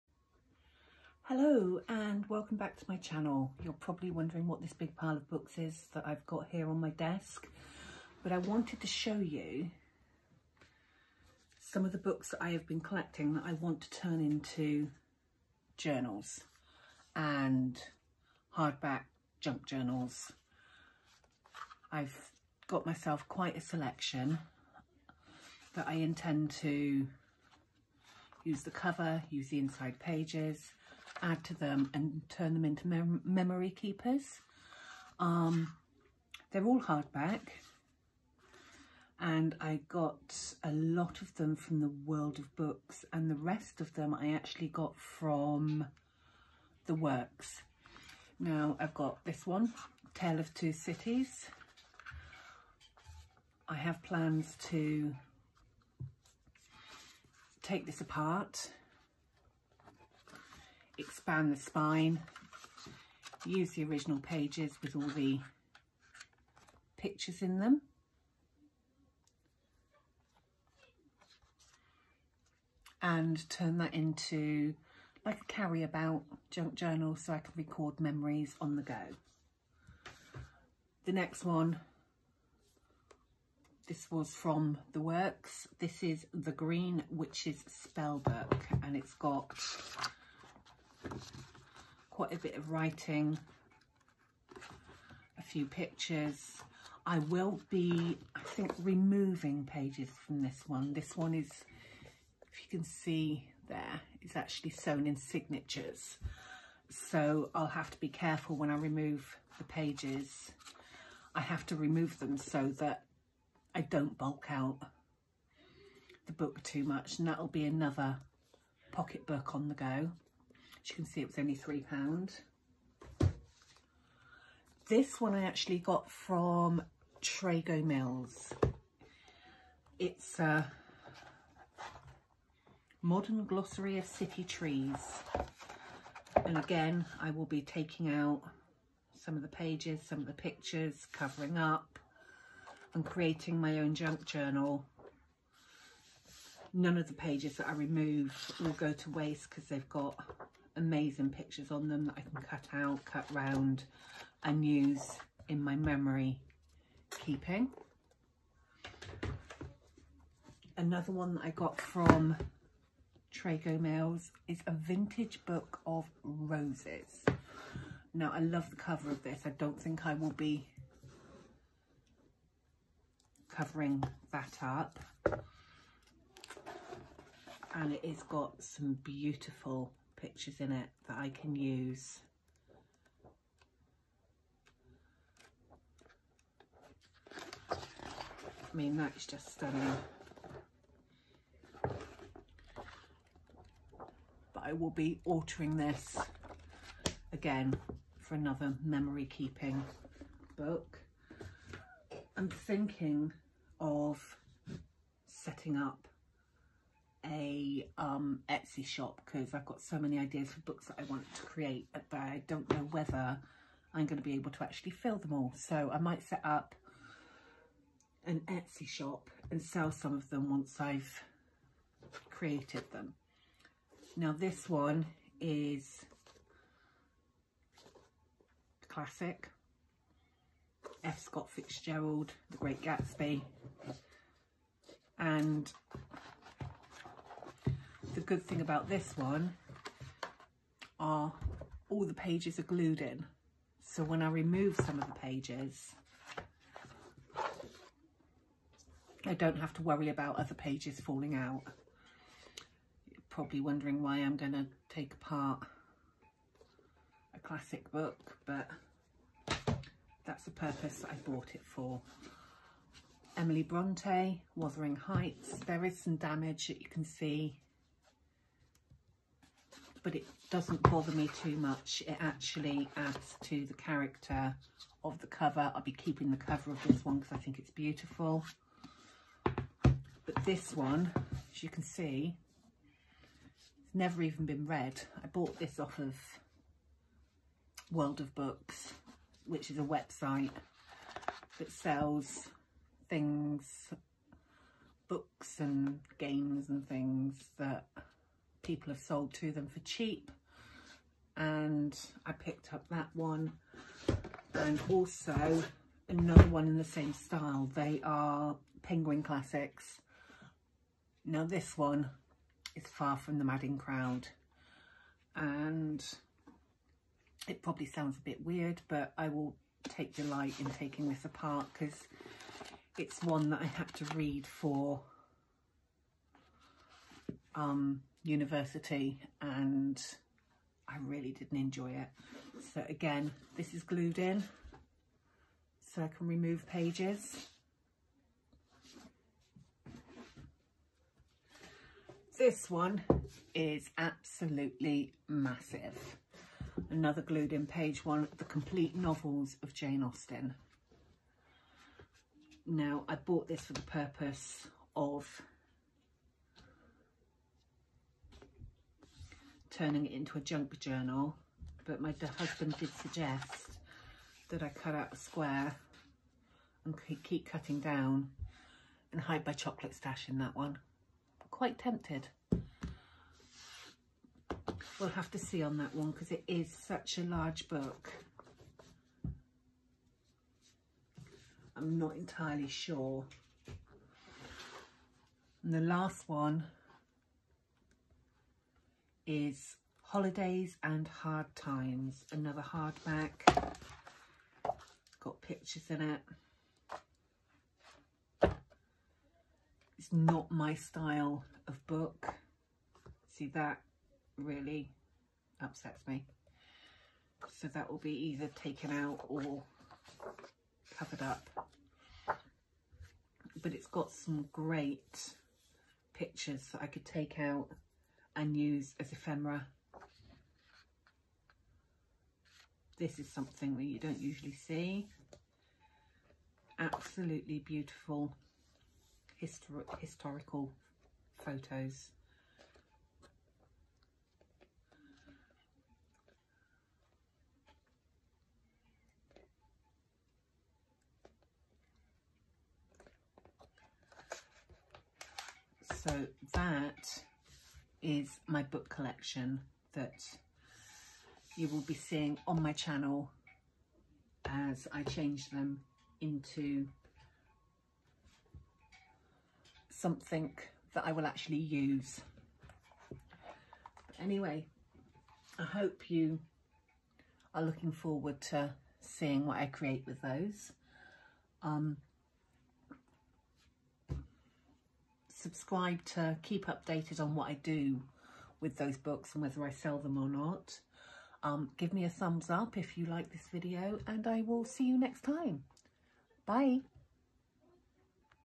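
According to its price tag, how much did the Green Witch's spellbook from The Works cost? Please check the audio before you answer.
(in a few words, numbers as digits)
£3.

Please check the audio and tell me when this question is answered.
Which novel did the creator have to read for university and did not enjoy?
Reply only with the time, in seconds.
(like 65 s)
312 s.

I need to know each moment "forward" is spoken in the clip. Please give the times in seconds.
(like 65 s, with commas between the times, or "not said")
467 s.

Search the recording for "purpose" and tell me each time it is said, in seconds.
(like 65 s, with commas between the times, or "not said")
260 s, 353 s.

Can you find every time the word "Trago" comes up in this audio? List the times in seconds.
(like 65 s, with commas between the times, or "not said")
127 s, 163 s.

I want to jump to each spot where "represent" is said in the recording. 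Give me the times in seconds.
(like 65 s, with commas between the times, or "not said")
not said.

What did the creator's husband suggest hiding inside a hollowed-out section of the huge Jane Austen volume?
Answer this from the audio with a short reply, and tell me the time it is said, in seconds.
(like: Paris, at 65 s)
chocolate stash, at 369 s.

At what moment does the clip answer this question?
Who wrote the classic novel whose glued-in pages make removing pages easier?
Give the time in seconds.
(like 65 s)
231 s.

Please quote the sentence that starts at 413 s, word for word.
But it's got some great pictures that I could take out and use as ephemera.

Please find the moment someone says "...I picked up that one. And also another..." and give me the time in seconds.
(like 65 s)
302 s.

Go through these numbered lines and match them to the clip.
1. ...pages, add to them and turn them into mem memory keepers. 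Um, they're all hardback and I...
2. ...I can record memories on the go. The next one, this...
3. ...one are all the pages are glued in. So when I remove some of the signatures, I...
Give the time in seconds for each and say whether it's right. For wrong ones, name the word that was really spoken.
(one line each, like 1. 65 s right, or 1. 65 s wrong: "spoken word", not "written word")
1. 29 s right
2. 77 s right
3. 239 s wrong: "pages", not "signatures".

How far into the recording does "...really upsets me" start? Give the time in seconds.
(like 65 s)
404 s.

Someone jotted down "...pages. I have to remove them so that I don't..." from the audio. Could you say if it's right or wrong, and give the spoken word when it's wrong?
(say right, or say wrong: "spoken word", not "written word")
right.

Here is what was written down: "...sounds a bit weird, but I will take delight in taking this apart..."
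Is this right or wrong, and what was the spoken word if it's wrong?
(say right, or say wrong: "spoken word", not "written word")
right.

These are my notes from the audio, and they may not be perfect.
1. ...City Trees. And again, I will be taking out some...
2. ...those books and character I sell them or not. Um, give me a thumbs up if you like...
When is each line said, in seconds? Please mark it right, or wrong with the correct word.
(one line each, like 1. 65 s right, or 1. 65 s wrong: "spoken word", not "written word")
1. 134 s right
2. 478 s wrong: "whether", not "character".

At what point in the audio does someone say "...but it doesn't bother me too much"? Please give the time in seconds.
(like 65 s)
270 s.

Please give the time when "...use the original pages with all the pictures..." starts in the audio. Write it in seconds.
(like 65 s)
63 s.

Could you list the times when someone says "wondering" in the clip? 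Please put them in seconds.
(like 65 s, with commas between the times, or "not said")
4 s, 253 s.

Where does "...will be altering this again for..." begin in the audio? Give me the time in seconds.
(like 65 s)
194 s.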